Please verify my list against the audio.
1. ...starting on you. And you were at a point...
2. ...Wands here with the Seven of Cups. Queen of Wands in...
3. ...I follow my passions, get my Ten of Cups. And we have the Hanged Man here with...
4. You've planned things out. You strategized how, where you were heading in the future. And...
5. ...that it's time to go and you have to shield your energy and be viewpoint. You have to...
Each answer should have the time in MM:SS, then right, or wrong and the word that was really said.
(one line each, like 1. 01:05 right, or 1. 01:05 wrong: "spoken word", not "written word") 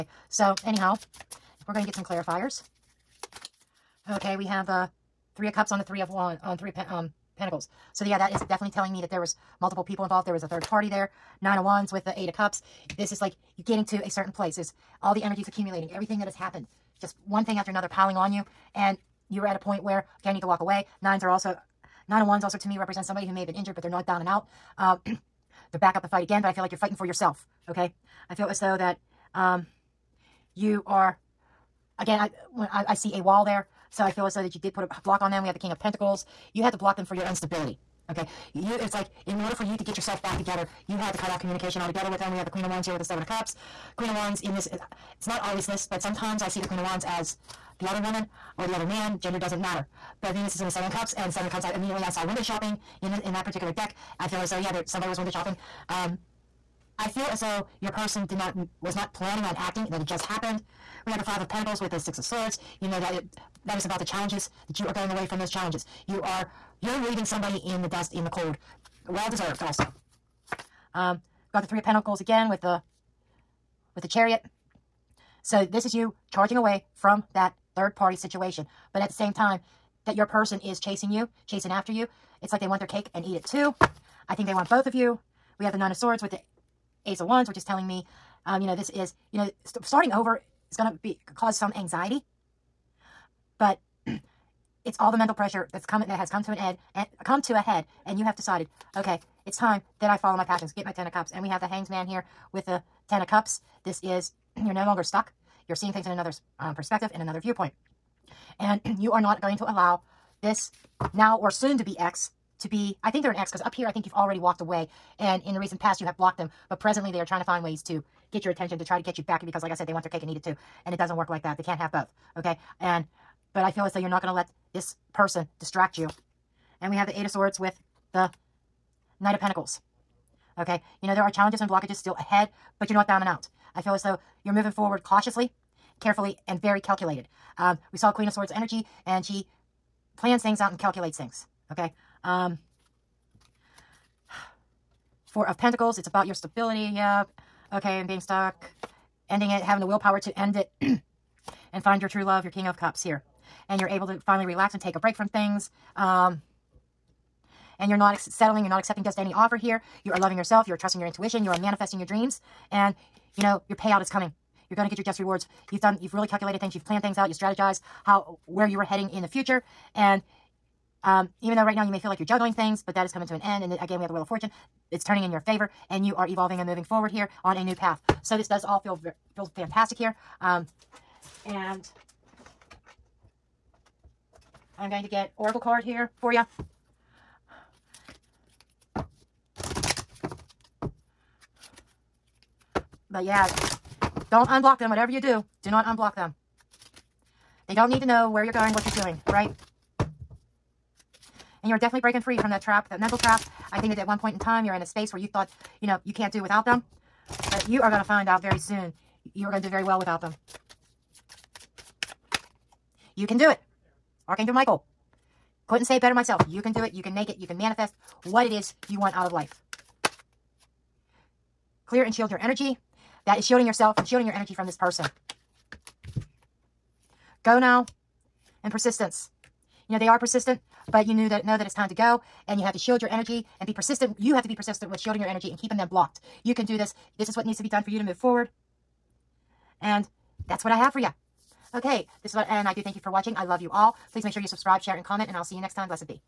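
1. 00:17 wrong: "piling", not "starting"
2. 00:42 right
3. 01:40 right
4. 02:46 right
5. 03:51 wrong: "persistent", not "viewpoint".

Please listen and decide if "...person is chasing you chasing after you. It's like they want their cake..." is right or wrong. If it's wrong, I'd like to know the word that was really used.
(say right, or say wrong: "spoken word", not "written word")
right.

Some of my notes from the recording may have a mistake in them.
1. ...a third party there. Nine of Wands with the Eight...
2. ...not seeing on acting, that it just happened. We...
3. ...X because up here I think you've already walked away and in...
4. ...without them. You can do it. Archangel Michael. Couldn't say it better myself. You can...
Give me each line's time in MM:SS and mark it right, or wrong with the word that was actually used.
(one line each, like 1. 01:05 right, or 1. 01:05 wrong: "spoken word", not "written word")
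1. 00:10 right
2. 00:58 wrong: "planning", not "seeing"
3. 01:53 right
4. 03:29 right.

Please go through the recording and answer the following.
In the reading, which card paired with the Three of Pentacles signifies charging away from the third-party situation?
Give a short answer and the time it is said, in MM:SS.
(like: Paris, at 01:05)
The Chariot, at 01:14.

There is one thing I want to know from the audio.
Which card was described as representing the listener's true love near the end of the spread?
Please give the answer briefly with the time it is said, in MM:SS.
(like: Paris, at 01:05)
King of Cups, at 02:32.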